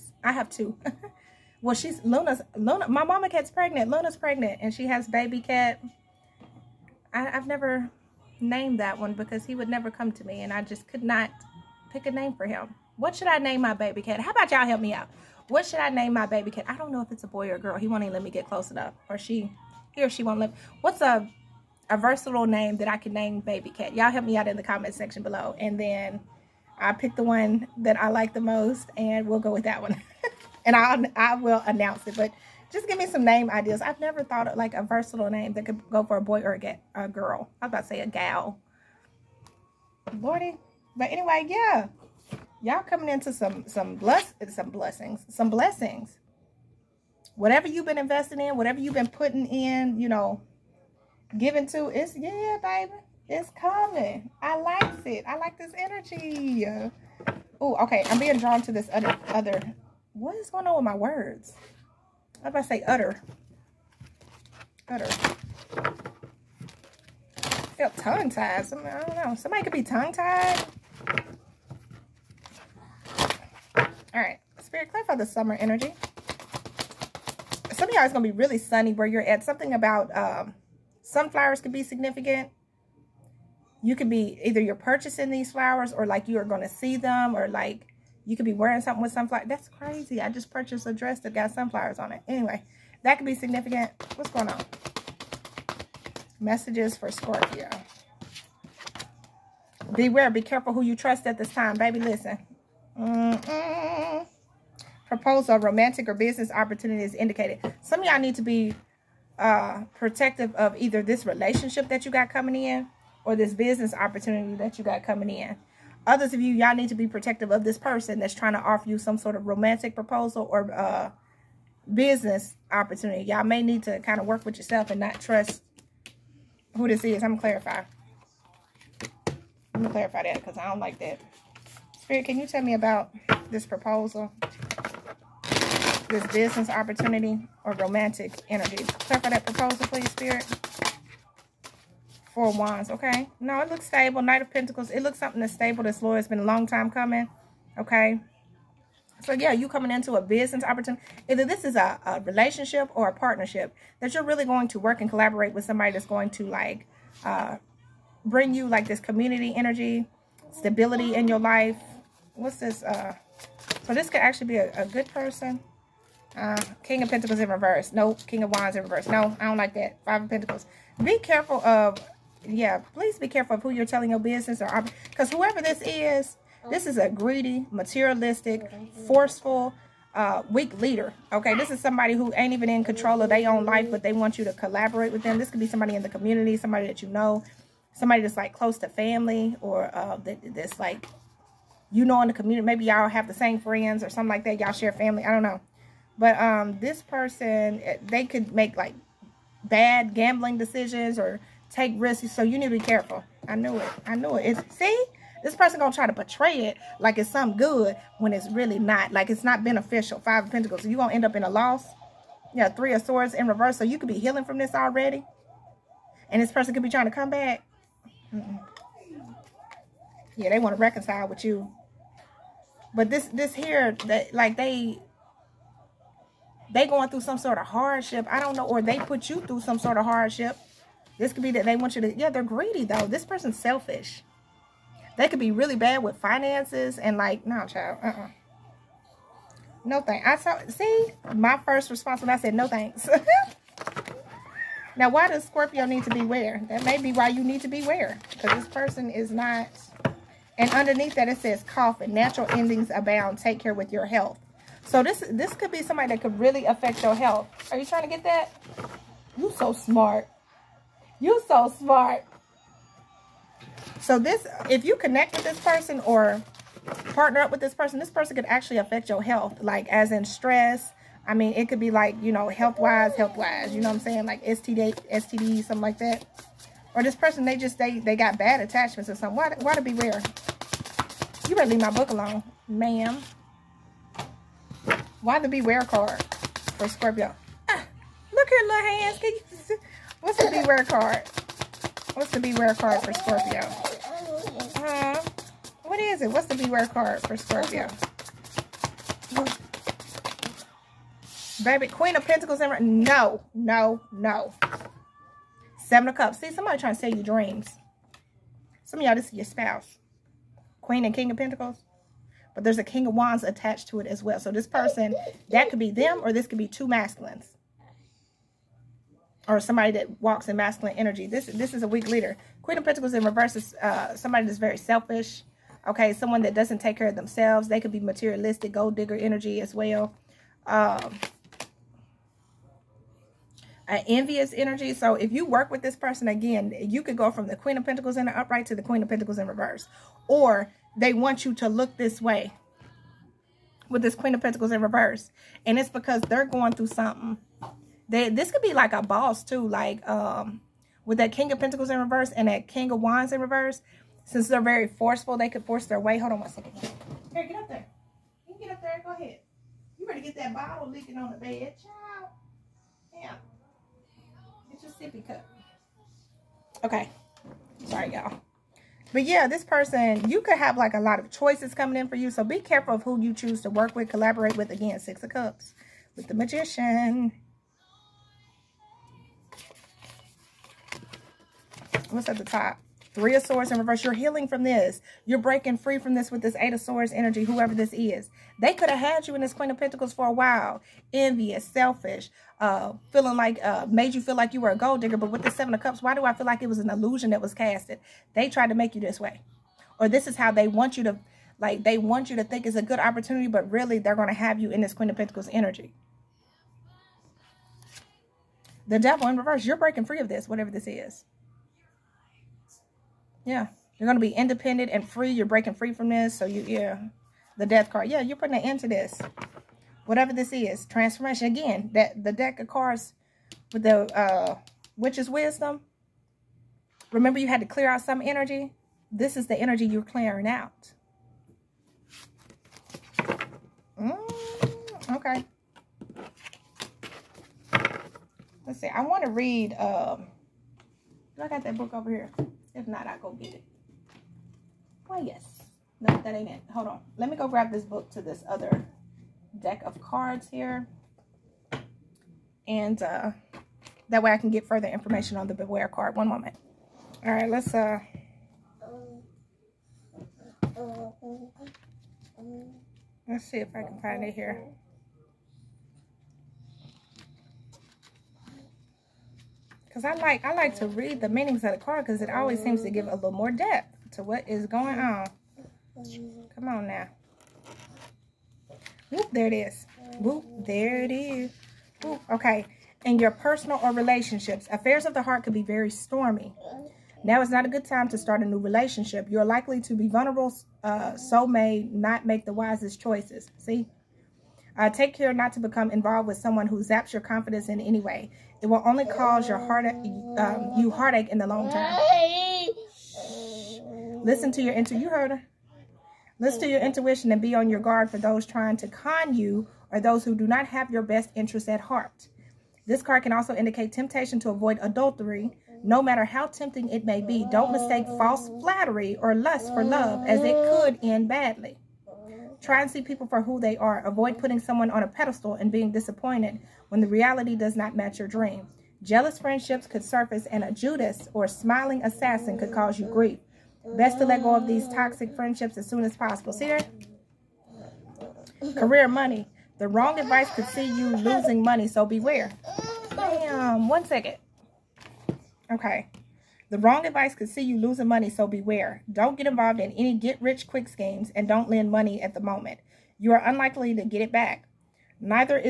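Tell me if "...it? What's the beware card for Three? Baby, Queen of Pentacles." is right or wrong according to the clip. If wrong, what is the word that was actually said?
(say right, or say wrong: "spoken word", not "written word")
wrong: "Scorpio", not "Three".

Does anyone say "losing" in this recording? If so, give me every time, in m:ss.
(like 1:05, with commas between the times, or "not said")
9:01, 9:07.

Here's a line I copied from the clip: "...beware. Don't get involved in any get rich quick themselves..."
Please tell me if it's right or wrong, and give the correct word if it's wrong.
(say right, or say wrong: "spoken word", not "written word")
wrong: "schemes", not "themselves".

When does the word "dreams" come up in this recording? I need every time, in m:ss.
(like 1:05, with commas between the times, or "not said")
5:07, 8:48.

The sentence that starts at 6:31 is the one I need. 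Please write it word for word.
Envious, selfish, uh, feeling like, uh, made you feel like you were a gold digger.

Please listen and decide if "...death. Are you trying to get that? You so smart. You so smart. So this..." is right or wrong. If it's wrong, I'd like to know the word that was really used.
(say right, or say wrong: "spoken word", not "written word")
wrong: "health", not "death".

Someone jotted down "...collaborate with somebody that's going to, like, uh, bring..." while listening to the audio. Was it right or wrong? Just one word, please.
right.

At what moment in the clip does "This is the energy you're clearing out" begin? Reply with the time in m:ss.
7:09.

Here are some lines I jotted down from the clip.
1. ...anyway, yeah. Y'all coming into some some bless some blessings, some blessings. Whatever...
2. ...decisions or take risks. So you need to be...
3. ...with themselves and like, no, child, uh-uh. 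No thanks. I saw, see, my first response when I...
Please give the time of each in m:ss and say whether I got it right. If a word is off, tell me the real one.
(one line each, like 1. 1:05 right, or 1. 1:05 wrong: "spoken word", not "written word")
1. 0:41 right
2. 3:20 right
3. 3:56 wrong: "finances", not "themselves".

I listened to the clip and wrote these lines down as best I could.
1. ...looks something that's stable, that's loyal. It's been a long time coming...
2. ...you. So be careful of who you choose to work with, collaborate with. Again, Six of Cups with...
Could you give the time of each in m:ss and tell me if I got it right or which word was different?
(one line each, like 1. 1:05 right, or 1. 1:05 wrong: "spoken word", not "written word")
1. 2:25 right
2. 6:12 right.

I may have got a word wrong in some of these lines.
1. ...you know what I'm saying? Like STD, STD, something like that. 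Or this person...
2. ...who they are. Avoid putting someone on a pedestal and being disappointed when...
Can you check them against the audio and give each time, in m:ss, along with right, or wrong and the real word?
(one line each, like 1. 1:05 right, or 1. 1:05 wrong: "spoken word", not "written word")
1. 4:33 right
2. 8:43 right.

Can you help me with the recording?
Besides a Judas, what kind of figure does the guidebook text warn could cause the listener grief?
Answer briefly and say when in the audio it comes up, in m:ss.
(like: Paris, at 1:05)
Smiling assassin, at 8:51.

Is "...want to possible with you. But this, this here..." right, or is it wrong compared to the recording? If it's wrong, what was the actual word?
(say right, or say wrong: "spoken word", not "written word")
wrong: "reconcile", not "possible".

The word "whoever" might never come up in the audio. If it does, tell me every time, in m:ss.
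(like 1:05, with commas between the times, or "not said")
2:55, 6:27.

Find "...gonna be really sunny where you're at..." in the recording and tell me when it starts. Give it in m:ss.
1:18.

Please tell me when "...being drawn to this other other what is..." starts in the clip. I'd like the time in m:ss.
0:58.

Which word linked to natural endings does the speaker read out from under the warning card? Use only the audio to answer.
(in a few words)
Coffin.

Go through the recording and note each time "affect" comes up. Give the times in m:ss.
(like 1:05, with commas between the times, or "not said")
4:16, 4:28.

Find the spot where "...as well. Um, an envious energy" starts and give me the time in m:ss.
5:29.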